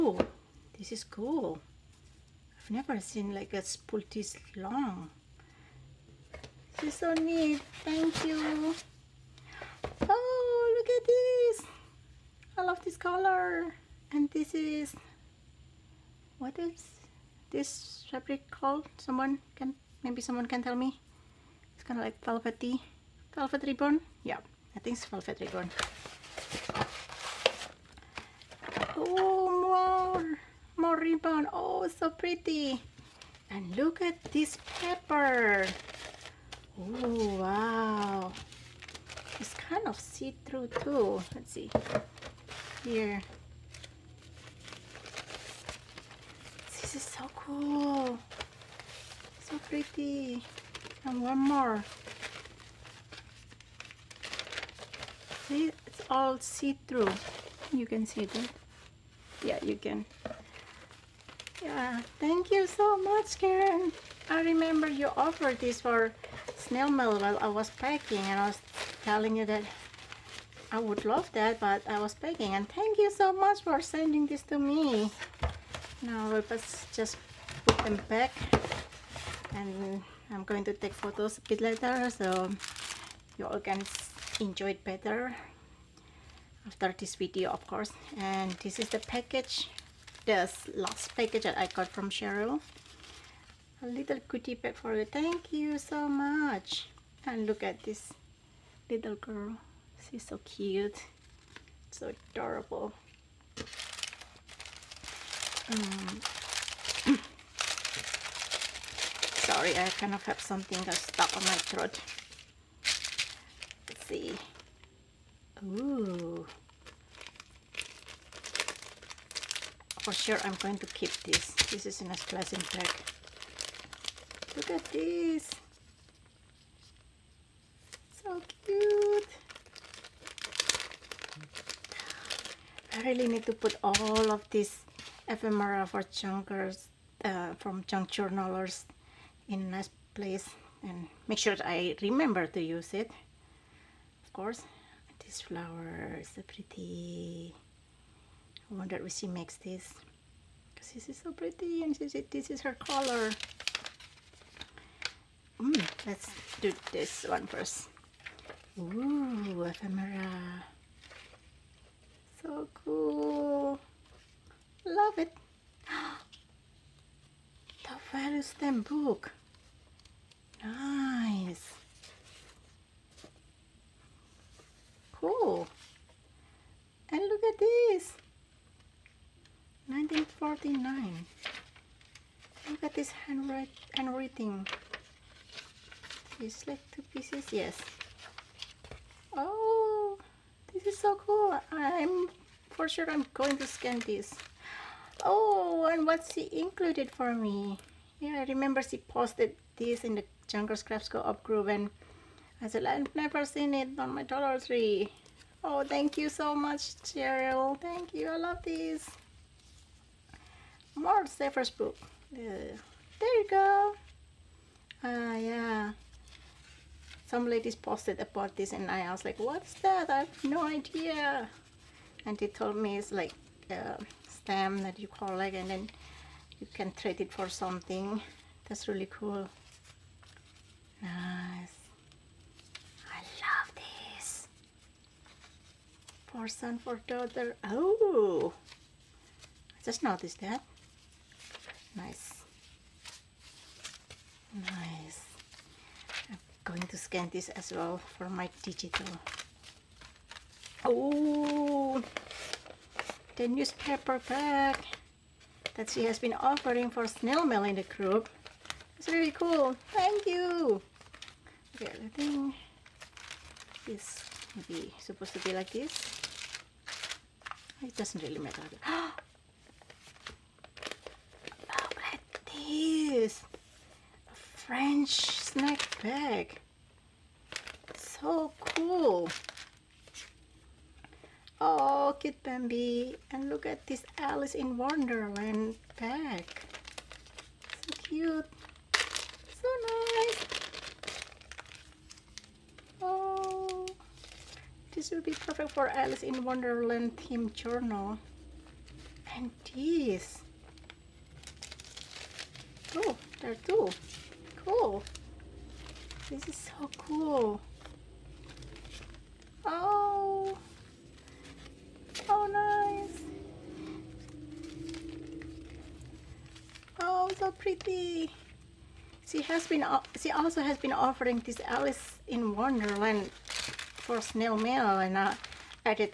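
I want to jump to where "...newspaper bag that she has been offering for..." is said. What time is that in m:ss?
4:13.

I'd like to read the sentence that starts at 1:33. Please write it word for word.
A little cutie pet for you.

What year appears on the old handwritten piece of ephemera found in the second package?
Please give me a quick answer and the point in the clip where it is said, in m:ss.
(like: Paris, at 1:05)
1949, at 2:59.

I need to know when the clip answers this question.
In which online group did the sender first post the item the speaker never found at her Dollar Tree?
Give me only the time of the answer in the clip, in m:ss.
3:20.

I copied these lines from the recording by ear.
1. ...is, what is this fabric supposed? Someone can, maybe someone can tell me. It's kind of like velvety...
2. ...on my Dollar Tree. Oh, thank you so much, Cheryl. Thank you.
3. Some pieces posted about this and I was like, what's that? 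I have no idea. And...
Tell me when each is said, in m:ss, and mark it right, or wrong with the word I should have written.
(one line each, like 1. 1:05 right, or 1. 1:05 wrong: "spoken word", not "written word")
1. 0:14 wrong: "called", not "supposed"
2. 3:23 right
3. 3:37 wrong: "ladies", not "pieces".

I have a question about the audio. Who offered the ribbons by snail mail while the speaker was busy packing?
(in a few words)
Karen.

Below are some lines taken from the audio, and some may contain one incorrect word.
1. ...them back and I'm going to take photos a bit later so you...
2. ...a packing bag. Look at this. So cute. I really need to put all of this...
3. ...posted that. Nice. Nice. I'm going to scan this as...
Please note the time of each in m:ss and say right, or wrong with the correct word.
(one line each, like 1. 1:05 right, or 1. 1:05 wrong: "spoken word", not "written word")
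1. 1:17 right
2. 2:02 wrong: "dressing", not "packing"
3. 4:00 wrong: "noticed", not "posted".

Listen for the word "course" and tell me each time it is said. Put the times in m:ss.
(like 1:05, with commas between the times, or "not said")
1:27, 2:24.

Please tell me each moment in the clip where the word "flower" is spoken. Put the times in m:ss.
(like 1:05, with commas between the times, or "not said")
2:25.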